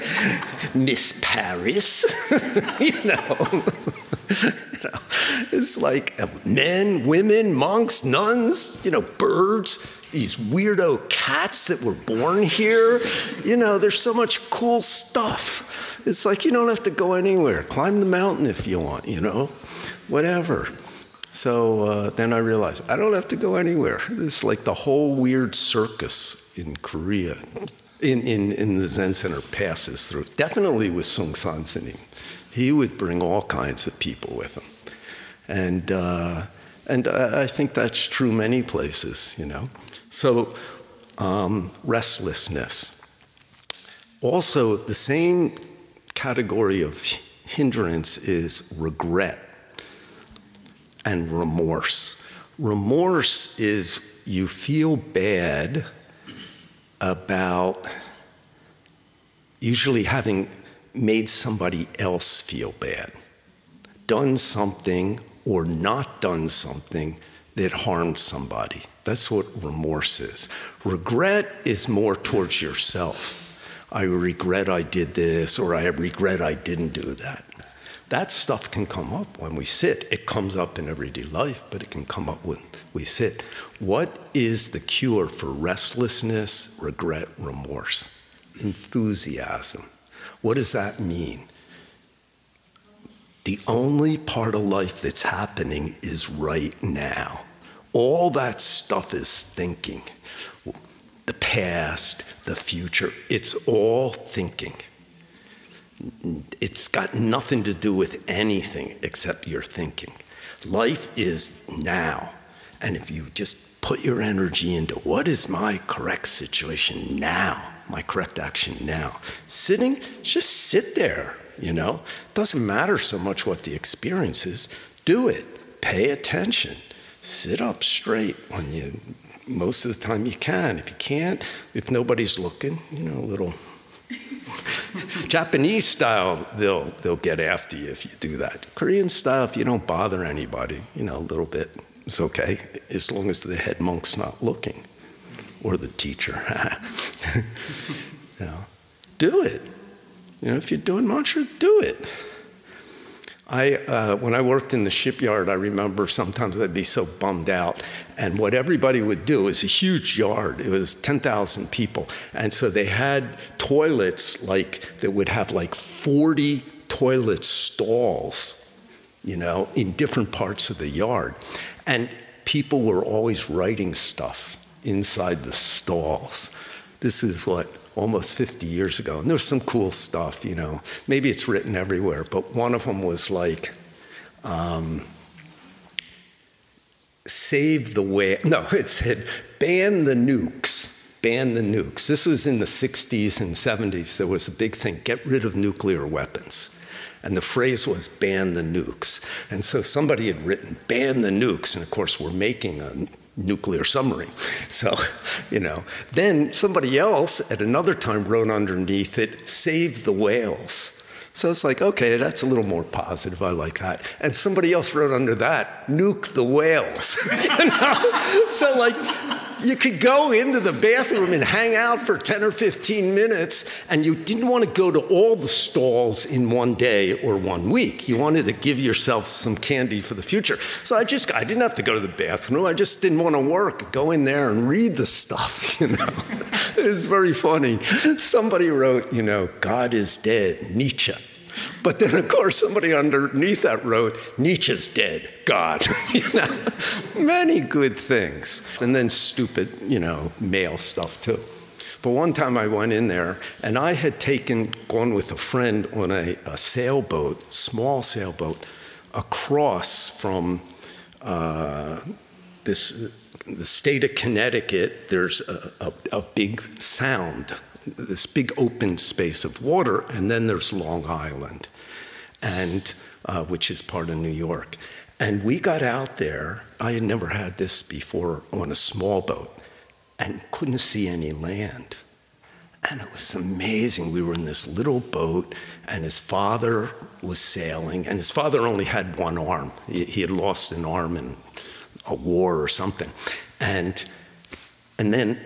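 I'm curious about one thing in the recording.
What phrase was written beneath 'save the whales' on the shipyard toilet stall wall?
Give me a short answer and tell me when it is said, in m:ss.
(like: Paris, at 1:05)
Nuke the whales, at 3:35.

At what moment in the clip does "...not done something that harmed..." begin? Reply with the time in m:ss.
1:05.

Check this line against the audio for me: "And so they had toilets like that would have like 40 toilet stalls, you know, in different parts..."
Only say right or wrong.
right.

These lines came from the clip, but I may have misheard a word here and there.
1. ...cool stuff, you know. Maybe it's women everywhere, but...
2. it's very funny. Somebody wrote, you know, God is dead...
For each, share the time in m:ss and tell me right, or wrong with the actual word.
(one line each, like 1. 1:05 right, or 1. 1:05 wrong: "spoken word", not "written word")
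1. 2:59 wrong: "written", not "women"
2. 3:56 right.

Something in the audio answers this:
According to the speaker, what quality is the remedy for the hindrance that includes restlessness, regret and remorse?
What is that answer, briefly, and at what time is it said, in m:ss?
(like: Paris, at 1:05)
Enthusiasm, at 1:28.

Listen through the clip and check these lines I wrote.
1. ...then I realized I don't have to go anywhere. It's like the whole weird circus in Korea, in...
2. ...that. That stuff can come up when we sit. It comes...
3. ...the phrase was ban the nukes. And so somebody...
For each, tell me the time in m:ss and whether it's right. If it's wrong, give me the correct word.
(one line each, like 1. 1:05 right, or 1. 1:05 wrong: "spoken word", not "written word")
1. 0:22 right
2. 1:17 right
3. 3:17 right.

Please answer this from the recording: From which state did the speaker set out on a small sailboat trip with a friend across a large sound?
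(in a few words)
Connecticut.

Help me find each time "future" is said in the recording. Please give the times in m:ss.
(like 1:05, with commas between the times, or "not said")
1:42, 3:50.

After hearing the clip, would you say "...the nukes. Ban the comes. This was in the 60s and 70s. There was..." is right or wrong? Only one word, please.
wrong.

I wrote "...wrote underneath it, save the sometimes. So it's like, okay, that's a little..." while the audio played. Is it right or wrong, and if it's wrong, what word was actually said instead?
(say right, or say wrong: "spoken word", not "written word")
wrong: "whales", not "sometimes".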